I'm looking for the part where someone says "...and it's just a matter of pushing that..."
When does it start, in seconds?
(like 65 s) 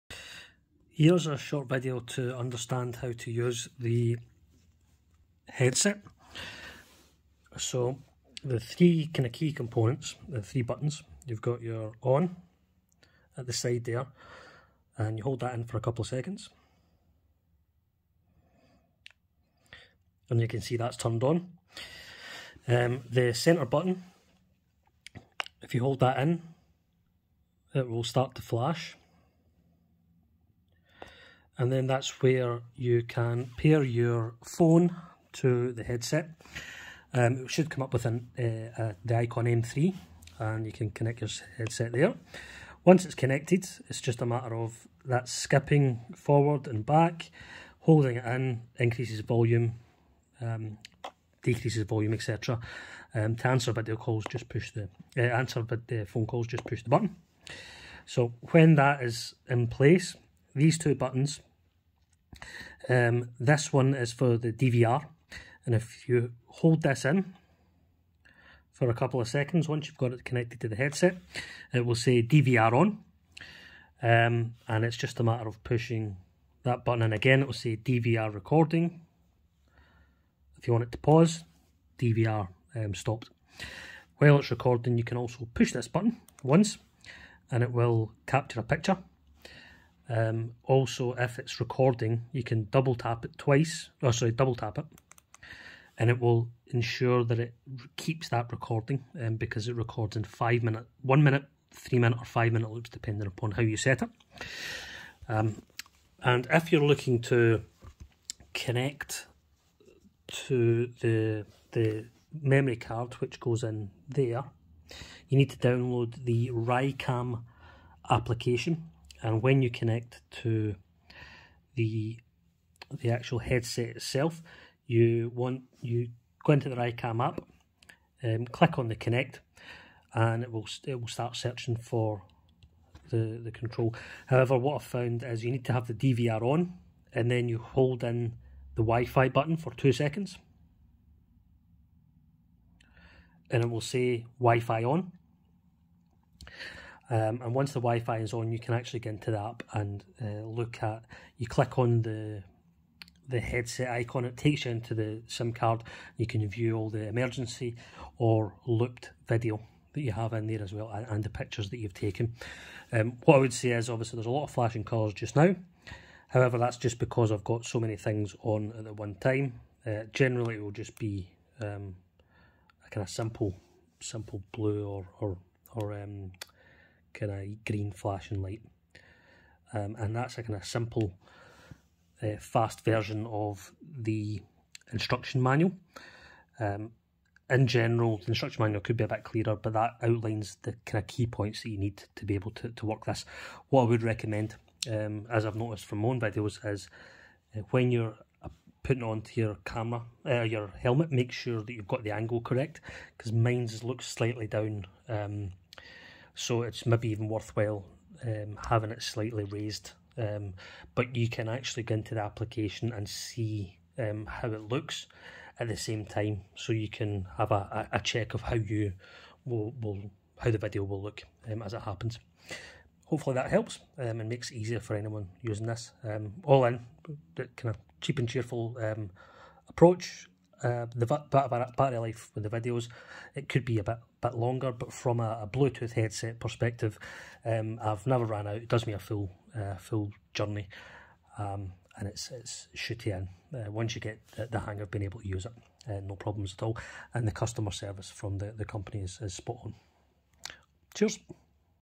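74 s.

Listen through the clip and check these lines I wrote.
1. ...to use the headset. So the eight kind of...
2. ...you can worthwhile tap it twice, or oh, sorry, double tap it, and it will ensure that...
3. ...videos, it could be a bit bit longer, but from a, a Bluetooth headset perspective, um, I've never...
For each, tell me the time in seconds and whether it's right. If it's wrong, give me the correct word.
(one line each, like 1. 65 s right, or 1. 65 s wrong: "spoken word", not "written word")
1. 3 s wrong: "three", not "eight"
2. 92 s wrong: "double", not "worthwhile"
3. 232 s right.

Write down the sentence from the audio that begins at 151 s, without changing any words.
You click on the the headset icon.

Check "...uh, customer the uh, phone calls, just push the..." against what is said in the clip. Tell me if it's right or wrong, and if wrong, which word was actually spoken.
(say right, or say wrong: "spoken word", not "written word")
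wrong: "answer", not "customer".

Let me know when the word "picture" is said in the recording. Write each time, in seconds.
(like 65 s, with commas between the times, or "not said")
88 s, 161 s.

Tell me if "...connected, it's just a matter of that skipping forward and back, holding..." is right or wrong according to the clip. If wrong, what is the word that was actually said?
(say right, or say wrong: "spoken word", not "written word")
right.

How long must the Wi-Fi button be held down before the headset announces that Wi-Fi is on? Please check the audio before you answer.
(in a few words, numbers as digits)
2 seconds.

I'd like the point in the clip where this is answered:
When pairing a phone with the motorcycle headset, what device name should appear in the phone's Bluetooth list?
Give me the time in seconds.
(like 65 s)
39 s.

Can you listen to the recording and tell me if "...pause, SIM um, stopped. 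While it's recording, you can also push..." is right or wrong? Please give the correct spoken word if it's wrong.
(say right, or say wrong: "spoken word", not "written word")
wrong: "DVR", not "SIM".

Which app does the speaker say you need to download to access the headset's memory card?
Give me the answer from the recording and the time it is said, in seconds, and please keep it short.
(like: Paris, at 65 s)
RICAM, at 116 s.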